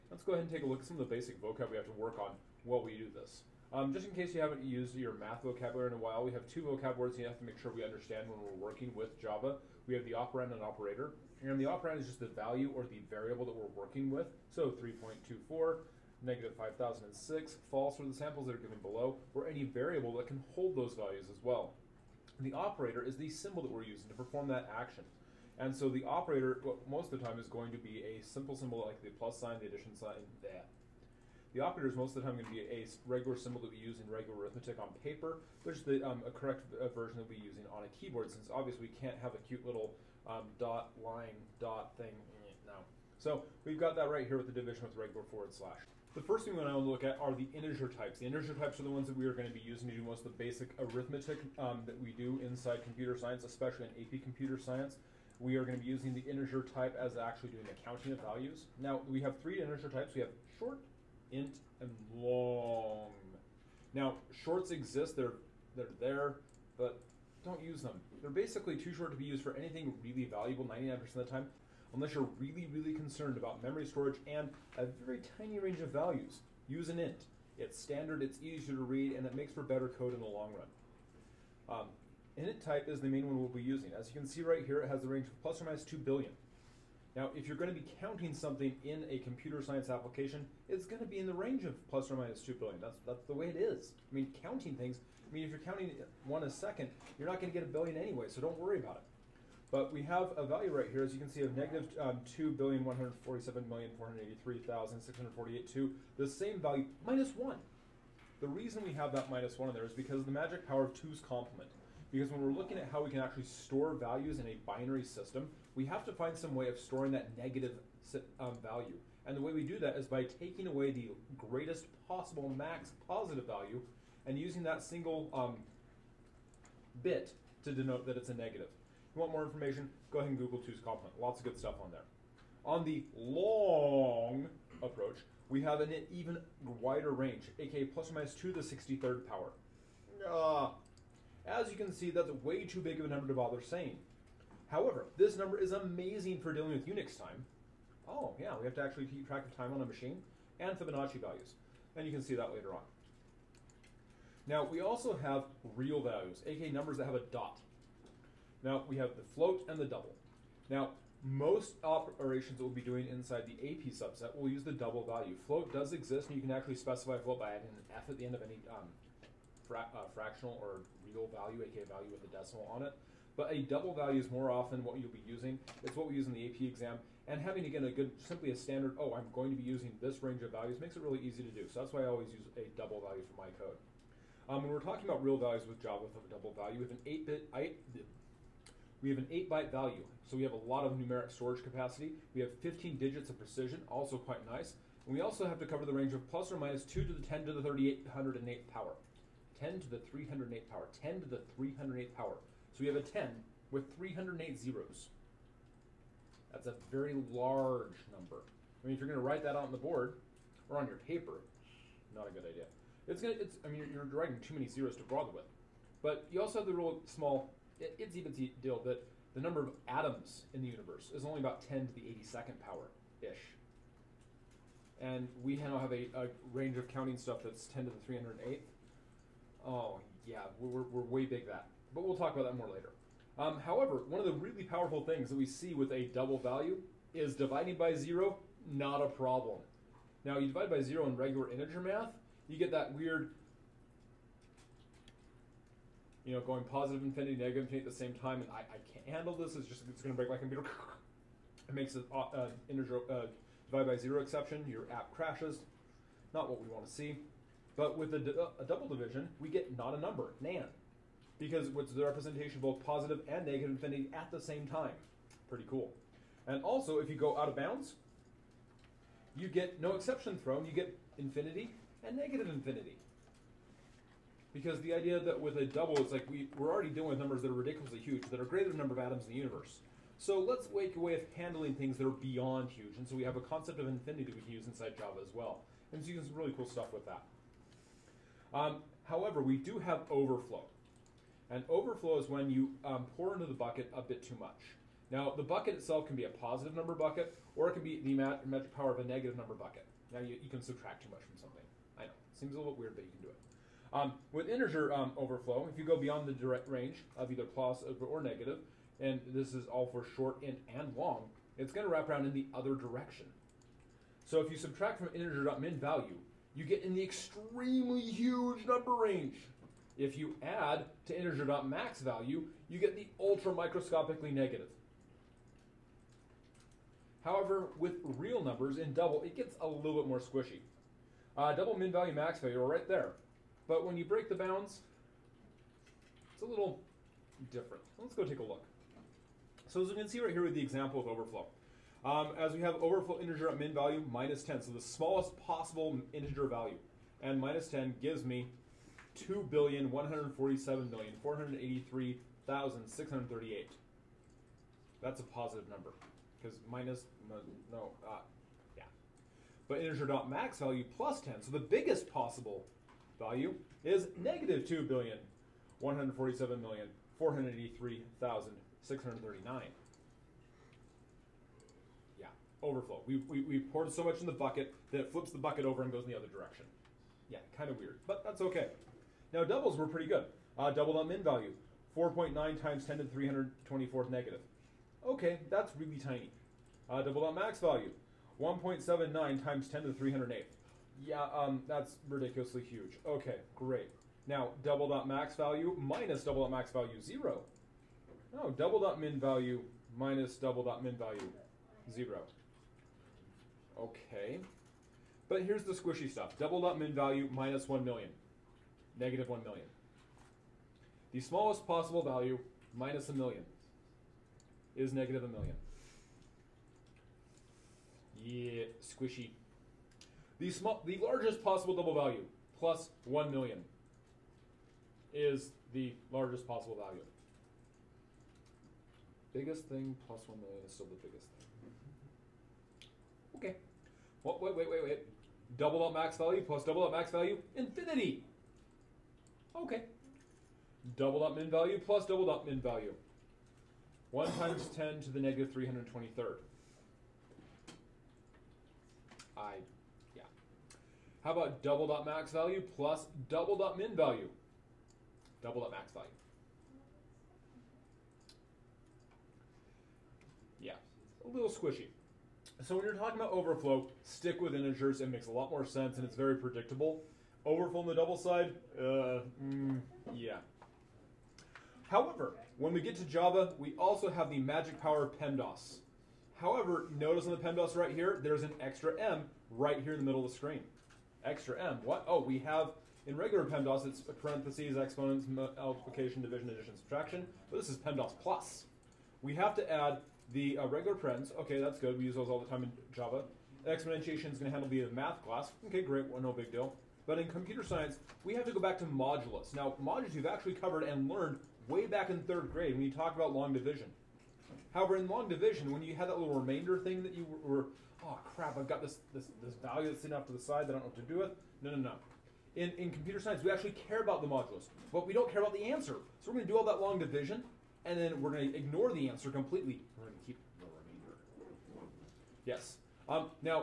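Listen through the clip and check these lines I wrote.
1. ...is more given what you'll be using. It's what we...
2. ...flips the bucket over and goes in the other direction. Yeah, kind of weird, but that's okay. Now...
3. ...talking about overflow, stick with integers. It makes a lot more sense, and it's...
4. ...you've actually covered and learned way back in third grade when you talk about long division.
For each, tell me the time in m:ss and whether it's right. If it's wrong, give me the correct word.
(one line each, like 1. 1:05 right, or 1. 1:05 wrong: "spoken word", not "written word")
1. 2:54 wrong: "often", not "given"
2. 6:15 right
3. 7:42 right
4. 8:20 right.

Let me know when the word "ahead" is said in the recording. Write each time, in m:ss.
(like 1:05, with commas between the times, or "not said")
0:00, 2:10.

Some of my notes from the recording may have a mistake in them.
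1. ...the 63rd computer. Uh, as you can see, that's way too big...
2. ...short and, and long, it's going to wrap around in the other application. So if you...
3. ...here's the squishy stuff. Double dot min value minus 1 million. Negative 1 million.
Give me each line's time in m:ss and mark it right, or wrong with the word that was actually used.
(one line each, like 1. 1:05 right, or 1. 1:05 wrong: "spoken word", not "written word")
1. 2:18 wrong: "power", not "computer"
2. 5:10 wrong: "direction", not "application"
3. 6:45 right.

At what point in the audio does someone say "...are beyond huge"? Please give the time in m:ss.
4:42.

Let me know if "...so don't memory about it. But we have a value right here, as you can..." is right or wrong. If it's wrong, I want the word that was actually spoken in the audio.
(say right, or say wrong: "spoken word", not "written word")
wrong: "worry", not "memory".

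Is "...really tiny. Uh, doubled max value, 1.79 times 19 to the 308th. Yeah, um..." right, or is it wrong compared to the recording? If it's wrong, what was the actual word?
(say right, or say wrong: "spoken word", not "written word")
wrong: "10", not "19".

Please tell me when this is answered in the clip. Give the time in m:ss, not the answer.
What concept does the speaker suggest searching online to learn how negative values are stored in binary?
2:10.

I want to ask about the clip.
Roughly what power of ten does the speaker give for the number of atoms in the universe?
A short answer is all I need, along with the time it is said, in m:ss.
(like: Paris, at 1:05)
10 to the 82nd, at 3:41.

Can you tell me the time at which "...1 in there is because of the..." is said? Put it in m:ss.
1:49.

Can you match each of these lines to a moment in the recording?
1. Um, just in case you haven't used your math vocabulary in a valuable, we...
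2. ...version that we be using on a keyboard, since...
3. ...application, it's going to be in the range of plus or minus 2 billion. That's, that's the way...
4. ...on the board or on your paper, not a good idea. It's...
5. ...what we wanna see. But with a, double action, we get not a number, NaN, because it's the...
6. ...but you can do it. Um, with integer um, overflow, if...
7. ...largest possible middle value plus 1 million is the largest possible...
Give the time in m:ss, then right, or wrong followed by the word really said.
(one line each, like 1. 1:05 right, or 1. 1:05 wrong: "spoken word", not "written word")
1. 0:03 wrong: "while", not "valuable"
2. 0:36 right
3. 1:29 right
4. 3:29 right
5. 4:16 wrong: "division", not "action"
6. 5:02 right
7. 7:01 wrong: "double", not "middle".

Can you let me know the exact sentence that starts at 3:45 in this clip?
And we now have a, a range of counting stuff that's 10 to the 308th Oh, yeah, we're, we're way big that.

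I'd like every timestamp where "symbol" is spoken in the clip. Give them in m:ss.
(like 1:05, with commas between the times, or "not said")
0:23, 0:28, 0:33.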